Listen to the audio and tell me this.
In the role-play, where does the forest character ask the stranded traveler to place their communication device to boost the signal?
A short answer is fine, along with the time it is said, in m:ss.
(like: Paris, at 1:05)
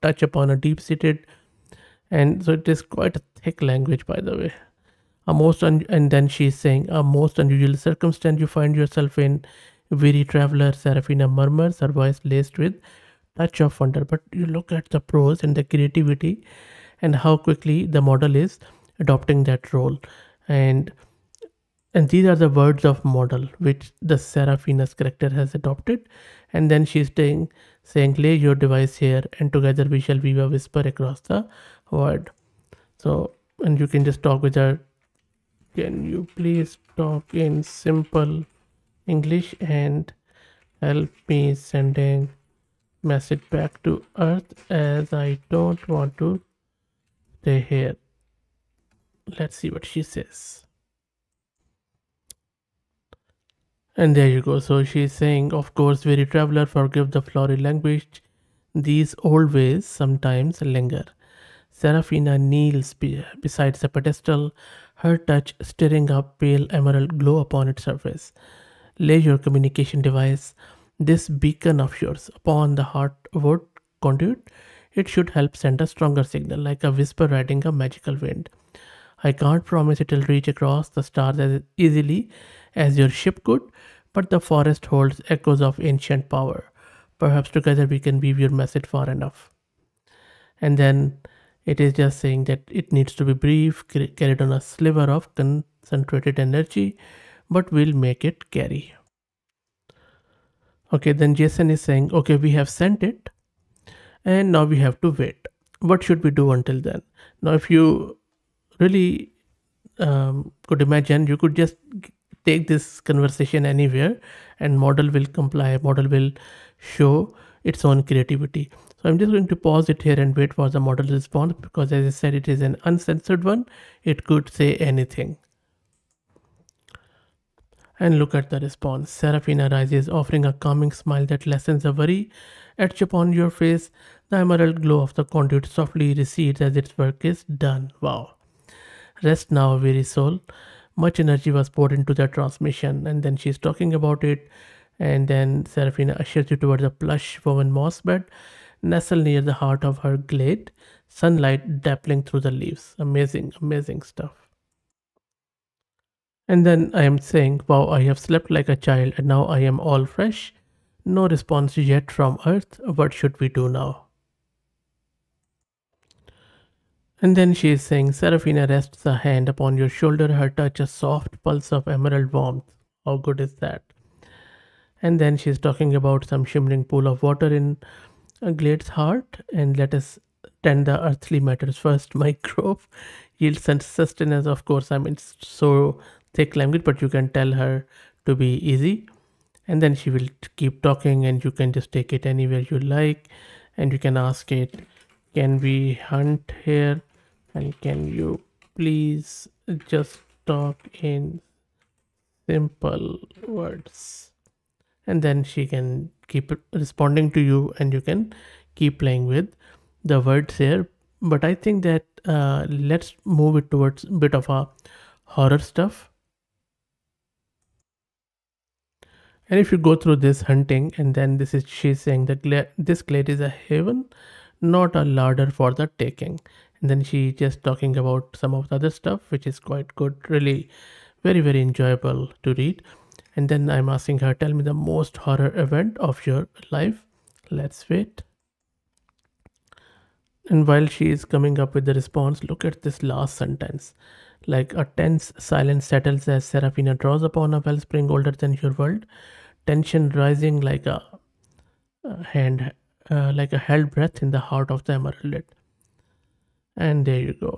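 Upon the wood conduit, at 1:12.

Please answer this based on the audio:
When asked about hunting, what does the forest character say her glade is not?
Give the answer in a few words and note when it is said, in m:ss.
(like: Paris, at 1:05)
A larder, at 3:44.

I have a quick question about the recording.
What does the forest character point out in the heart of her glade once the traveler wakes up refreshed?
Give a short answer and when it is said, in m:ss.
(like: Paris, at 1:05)
Shimmering pool of water, at 2:56.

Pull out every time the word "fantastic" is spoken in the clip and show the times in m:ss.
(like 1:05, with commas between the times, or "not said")
not said.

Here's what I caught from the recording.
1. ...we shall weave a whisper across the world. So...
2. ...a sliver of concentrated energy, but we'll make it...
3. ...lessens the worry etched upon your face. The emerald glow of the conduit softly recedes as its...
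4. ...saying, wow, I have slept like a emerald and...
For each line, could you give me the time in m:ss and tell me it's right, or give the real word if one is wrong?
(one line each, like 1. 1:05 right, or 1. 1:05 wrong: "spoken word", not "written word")
1. 0:29 right
2. 1:34 right
3. 2:11 right
4. 2:37 wrong: "child", not "emerald".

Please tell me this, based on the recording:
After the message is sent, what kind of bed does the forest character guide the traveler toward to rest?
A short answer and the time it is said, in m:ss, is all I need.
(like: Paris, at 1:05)
Plush woven moss bed, at 2:26.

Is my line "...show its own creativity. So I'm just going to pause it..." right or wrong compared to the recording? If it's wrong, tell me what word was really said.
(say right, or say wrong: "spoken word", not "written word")
right.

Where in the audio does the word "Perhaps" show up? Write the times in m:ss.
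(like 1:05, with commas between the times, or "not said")
1:27.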